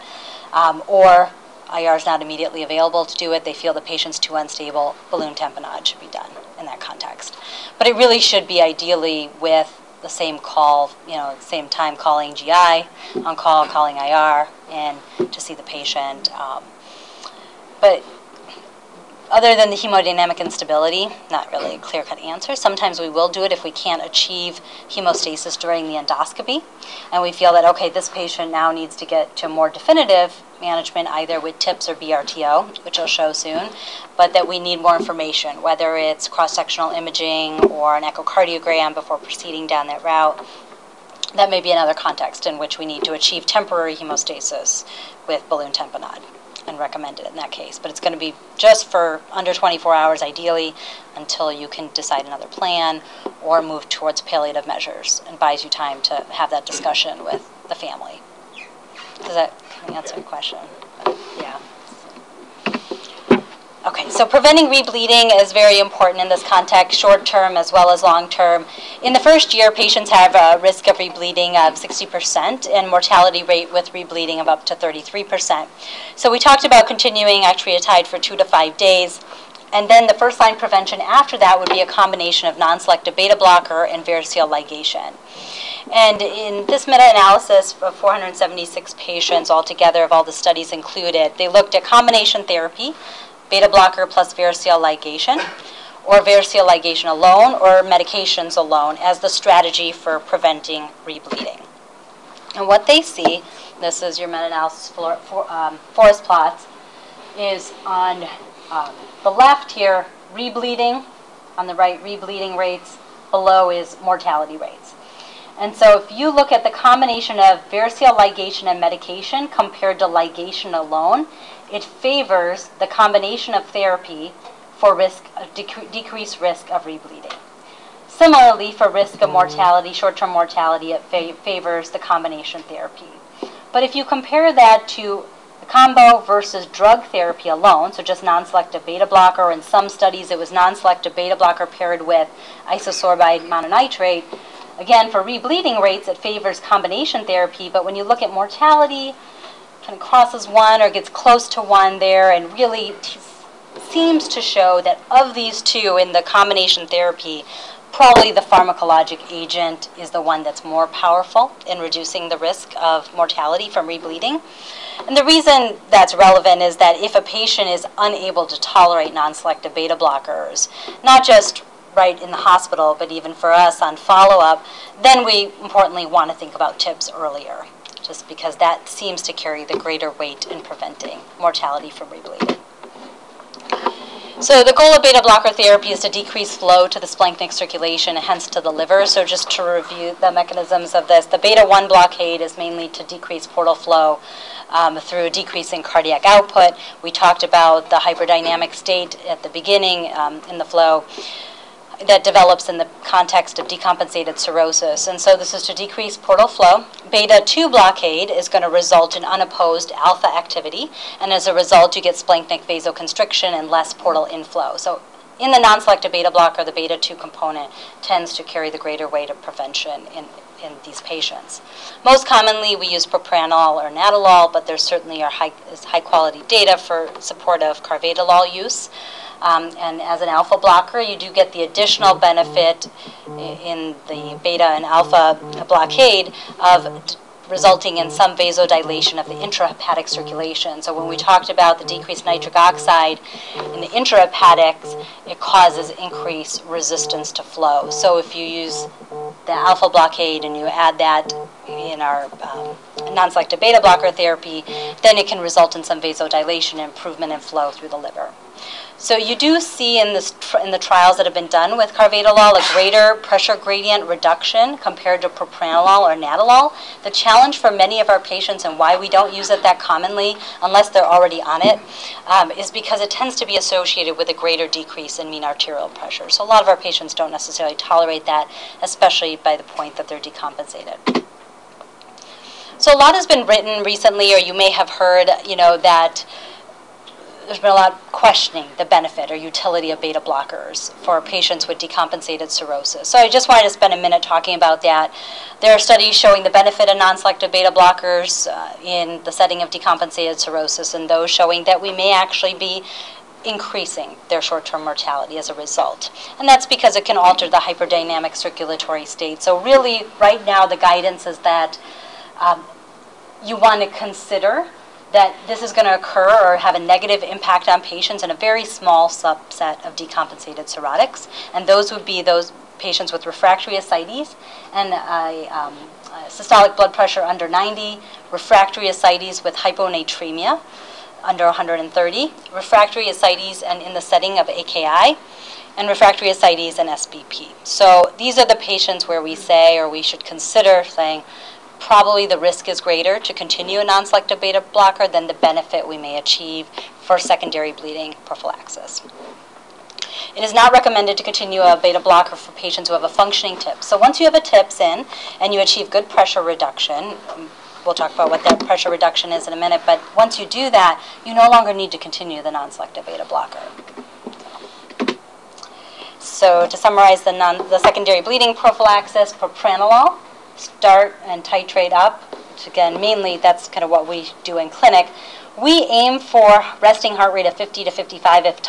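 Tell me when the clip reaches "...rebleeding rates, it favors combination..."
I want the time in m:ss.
2:25.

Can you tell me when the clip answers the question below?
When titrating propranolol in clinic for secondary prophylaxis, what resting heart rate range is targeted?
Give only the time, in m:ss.
6:17.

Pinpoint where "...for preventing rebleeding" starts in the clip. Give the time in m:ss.
1:39.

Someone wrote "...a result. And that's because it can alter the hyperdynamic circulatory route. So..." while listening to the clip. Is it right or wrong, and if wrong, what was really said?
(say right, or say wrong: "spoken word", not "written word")
wrong: "state", not "route".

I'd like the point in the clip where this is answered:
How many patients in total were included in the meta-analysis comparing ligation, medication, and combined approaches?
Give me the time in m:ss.
1:27.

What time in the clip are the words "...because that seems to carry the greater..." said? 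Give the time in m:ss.
2:58.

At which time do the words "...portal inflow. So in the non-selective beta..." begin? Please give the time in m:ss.
3:33.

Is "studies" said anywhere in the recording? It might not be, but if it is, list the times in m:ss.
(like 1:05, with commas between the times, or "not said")
1:30, 2:19, 4:55.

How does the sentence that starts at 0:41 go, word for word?
That may be another context in which we need to achieve temporary hemostasis with balloon tamponade been recommended in that case.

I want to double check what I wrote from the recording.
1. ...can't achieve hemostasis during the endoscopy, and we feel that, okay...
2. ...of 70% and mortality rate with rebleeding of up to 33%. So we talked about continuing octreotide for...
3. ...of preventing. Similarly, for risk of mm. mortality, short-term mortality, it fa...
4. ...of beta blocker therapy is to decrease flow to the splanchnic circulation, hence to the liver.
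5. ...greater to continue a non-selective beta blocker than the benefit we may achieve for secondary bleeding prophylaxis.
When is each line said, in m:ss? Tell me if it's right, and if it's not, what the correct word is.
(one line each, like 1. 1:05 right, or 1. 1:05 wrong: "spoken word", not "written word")
1. 0:23 right
2. 1:11 wrong: "60", not "70"
3. 2:06 wrong: "rebleeding", not "preventing"
4. 3:04 right
5. 5:42 right.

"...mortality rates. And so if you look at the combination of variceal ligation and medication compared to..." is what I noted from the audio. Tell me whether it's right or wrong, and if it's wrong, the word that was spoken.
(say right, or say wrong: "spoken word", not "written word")
right.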